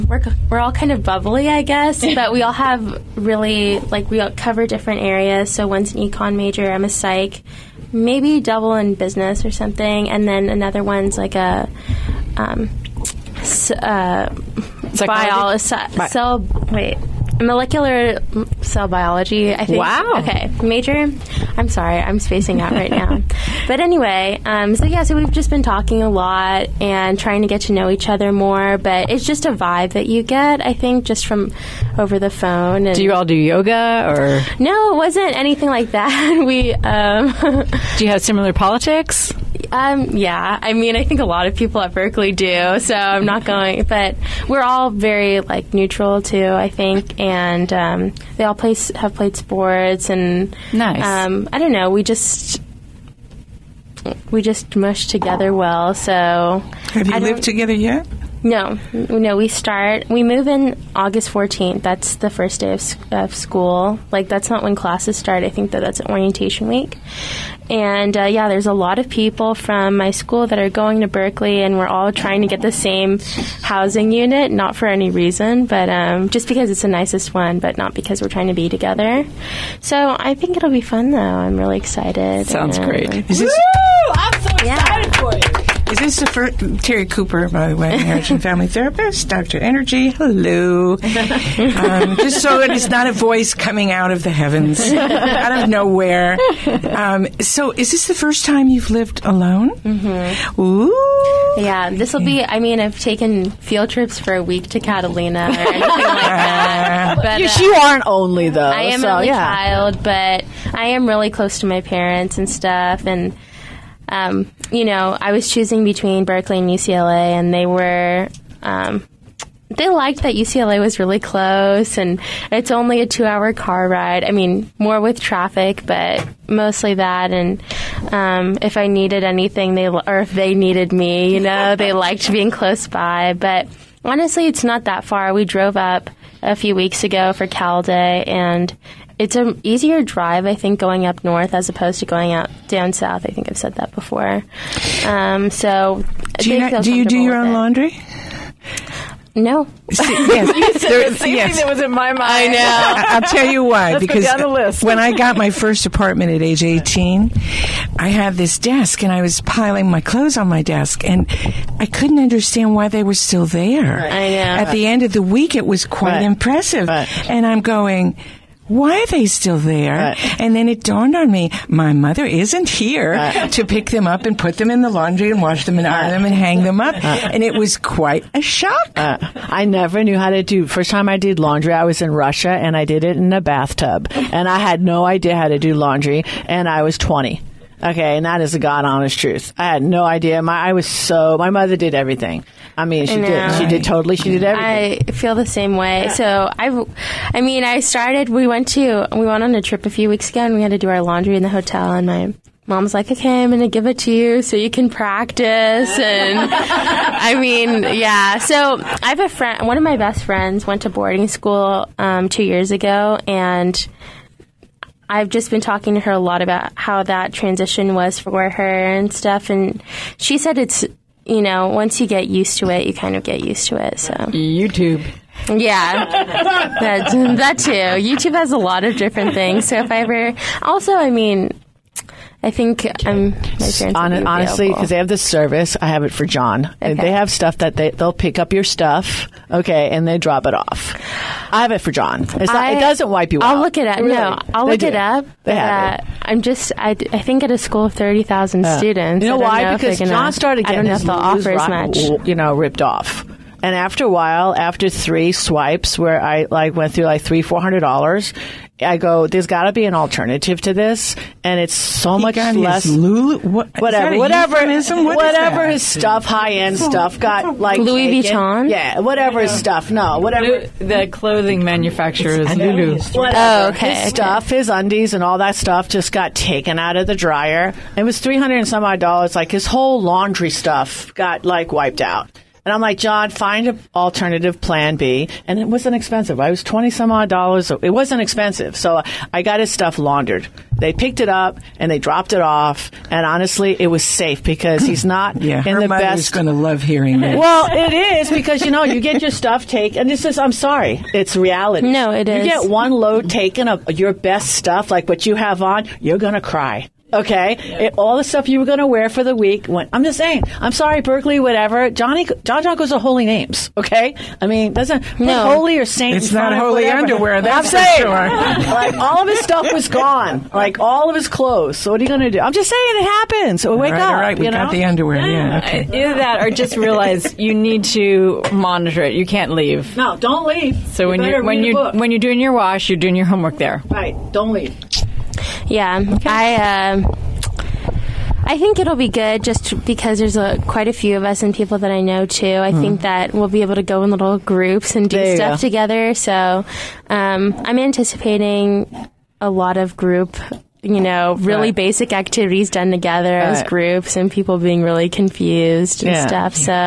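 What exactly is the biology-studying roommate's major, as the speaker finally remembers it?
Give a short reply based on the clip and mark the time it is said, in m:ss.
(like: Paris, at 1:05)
Molecular cell biology, at 0:17.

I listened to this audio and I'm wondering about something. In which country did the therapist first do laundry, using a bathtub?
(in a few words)
Russia.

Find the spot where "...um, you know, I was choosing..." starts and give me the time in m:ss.
1:54.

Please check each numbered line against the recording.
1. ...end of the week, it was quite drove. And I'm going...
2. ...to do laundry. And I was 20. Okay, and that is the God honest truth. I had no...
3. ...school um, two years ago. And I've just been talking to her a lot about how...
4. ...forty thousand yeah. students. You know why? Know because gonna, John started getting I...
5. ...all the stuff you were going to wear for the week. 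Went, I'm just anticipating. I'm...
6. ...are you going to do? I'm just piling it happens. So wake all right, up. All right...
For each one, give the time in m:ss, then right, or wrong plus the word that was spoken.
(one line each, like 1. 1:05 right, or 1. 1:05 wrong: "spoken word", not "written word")
1. 2:44 wrong: "impressive", not "drove"
2. 3:05 right
3. 3:31 right
4. 4:07 wrong: "thirty", not "forty"
5. 5:07 wrong: "saying", not "anticipating"
6. 5:22 wrong: "saying", not "piling".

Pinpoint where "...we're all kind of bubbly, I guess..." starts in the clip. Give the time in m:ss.
0:00.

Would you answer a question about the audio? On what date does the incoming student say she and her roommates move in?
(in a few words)
August 14.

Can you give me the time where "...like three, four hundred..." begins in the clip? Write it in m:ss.
4:17.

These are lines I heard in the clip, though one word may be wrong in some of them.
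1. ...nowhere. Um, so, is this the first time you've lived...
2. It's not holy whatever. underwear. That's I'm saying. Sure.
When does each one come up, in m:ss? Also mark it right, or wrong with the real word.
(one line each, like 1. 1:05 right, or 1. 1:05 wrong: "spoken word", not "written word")
1. 1:35 right
2. 5:16 right.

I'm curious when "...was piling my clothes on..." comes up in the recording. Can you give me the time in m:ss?
2:39.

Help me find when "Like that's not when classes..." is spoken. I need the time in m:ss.
1:04.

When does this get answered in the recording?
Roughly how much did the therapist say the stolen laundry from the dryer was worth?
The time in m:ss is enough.
4:38.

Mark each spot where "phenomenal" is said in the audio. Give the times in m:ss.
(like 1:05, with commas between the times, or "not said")
not said.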